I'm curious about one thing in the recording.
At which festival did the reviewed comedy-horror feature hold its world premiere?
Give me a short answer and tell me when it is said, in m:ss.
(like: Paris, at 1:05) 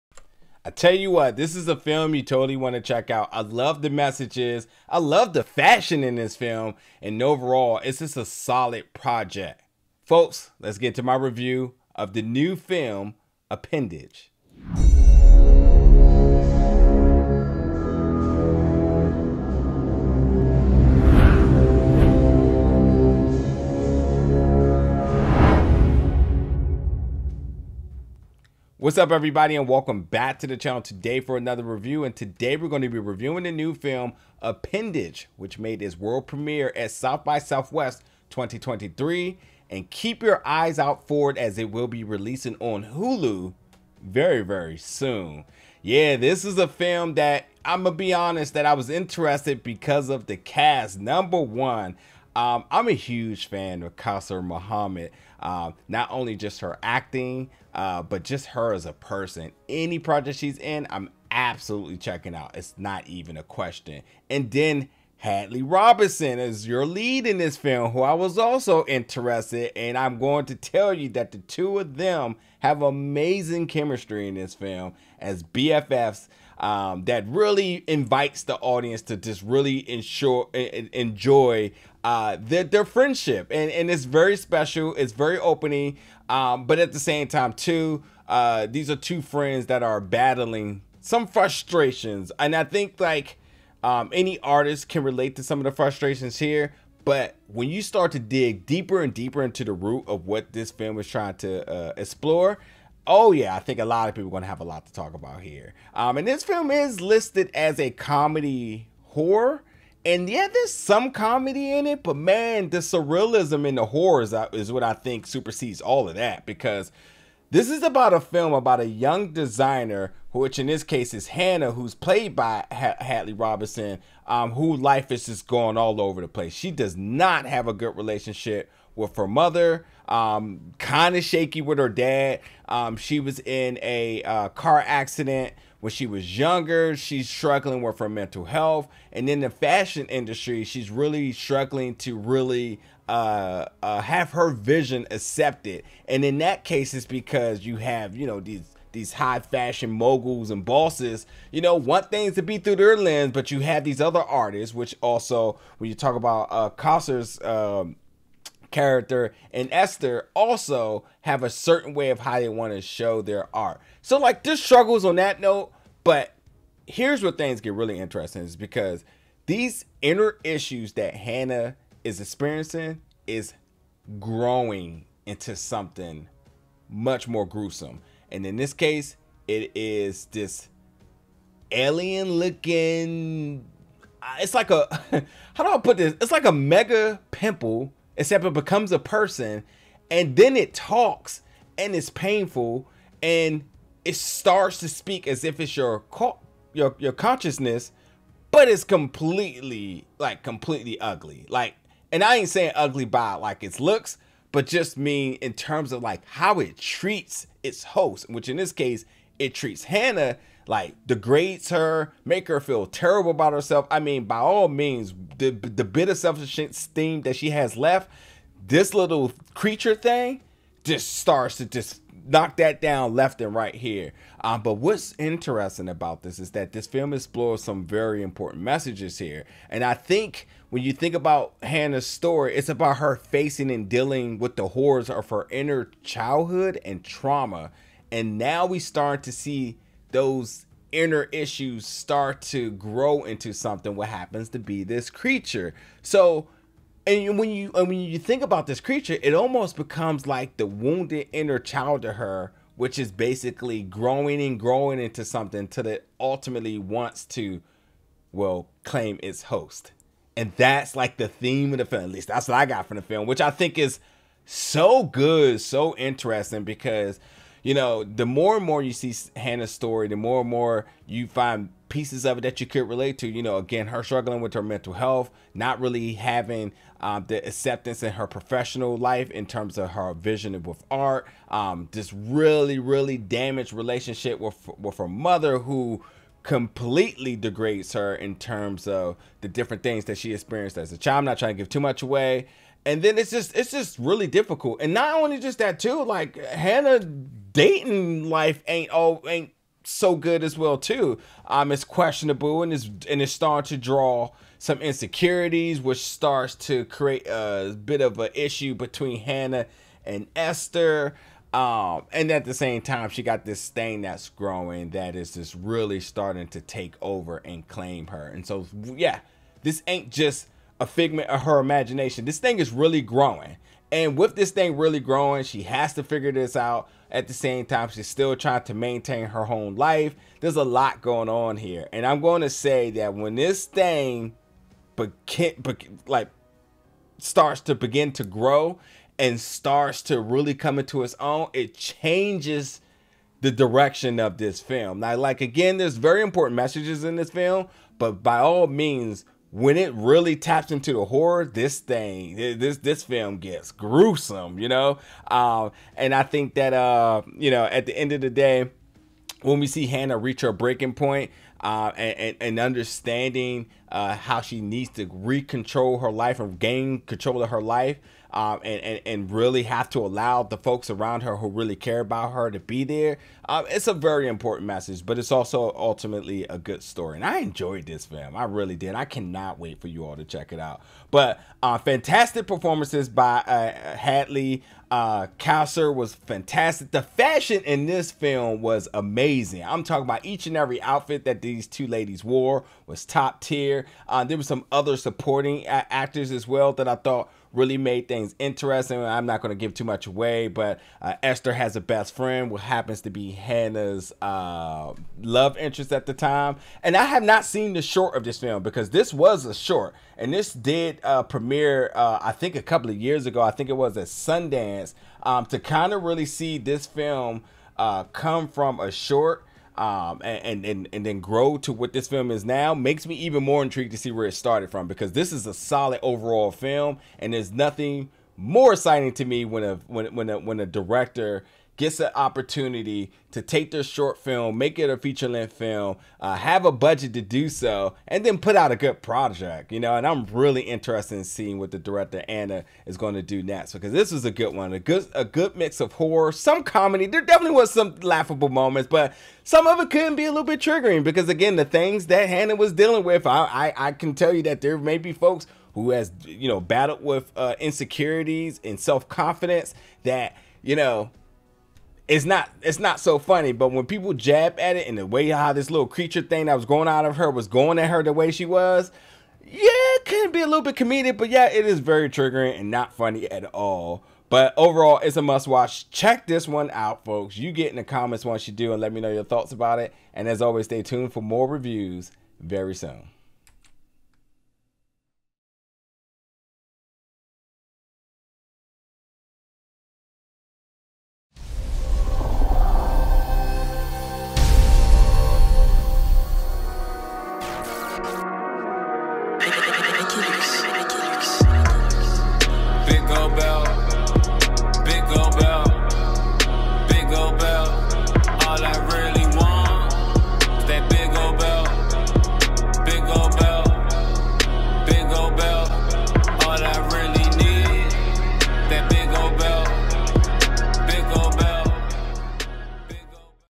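South by Southwest 2023, at 0:36.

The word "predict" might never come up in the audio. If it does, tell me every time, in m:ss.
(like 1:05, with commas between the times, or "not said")
not said.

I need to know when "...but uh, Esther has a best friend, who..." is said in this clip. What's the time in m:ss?
6:40.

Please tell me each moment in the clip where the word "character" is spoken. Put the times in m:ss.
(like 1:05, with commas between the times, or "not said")
2:38.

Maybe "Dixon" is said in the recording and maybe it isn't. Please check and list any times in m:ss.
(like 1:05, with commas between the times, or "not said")
not said.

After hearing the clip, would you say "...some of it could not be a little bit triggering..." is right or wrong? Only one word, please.
right.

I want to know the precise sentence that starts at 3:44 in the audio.
Um, but what's interesting about this is that this film explores some very important messages here.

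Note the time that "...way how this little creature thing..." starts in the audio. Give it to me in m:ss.
7:45.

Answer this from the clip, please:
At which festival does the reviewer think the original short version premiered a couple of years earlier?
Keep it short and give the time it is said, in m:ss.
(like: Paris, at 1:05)
Sundance, at 6:54.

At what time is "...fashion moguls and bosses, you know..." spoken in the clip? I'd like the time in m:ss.
2:29.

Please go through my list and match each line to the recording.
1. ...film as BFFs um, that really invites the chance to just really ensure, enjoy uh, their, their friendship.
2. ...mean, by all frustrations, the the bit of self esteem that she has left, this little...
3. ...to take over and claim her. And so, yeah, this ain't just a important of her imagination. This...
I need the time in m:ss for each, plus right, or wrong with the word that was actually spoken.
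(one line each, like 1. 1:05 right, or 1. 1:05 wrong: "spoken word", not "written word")
1. 1:14 wrong: "audience", not "chance"
2. 3:33 wrong: "means", not "frustrations"
3. 5:16 wrong: "figment", not "important".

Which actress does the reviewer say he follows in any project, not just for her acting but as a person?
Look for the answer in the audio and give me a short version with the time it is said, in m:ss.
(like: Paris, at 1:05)
Kausar Mohammed, at 0:53.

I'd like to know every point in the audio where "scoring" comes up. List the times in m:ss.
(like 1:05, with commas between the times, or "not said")
not said.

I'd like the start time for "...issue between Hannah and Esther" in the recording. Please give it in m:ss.
5:08.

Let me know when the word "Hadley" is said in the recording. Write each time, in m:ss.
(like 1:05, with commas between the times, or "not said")
1:05, 2:02, 6:23.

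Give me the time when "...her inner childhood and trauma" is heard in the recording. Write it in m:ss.
3:55.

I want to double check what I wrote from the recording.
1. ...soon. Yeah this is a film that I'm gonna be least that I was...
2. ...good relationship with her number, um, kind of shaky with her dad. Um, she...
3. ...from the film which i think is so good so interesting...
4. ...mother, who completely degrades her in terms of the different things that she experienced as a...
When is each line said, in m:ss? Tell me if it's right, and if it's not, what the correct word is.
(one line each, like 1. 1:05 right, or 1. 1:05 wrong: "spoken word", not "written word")
1. 0:44 wrong: "honest", not "least"
2. 2:07 wrong: "mother", not "number"
3. 4:22 right
4. 4:45 right.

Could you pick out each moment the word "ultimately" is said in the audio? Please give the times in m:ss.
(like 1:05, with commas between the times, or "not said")
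4:16, 6:15.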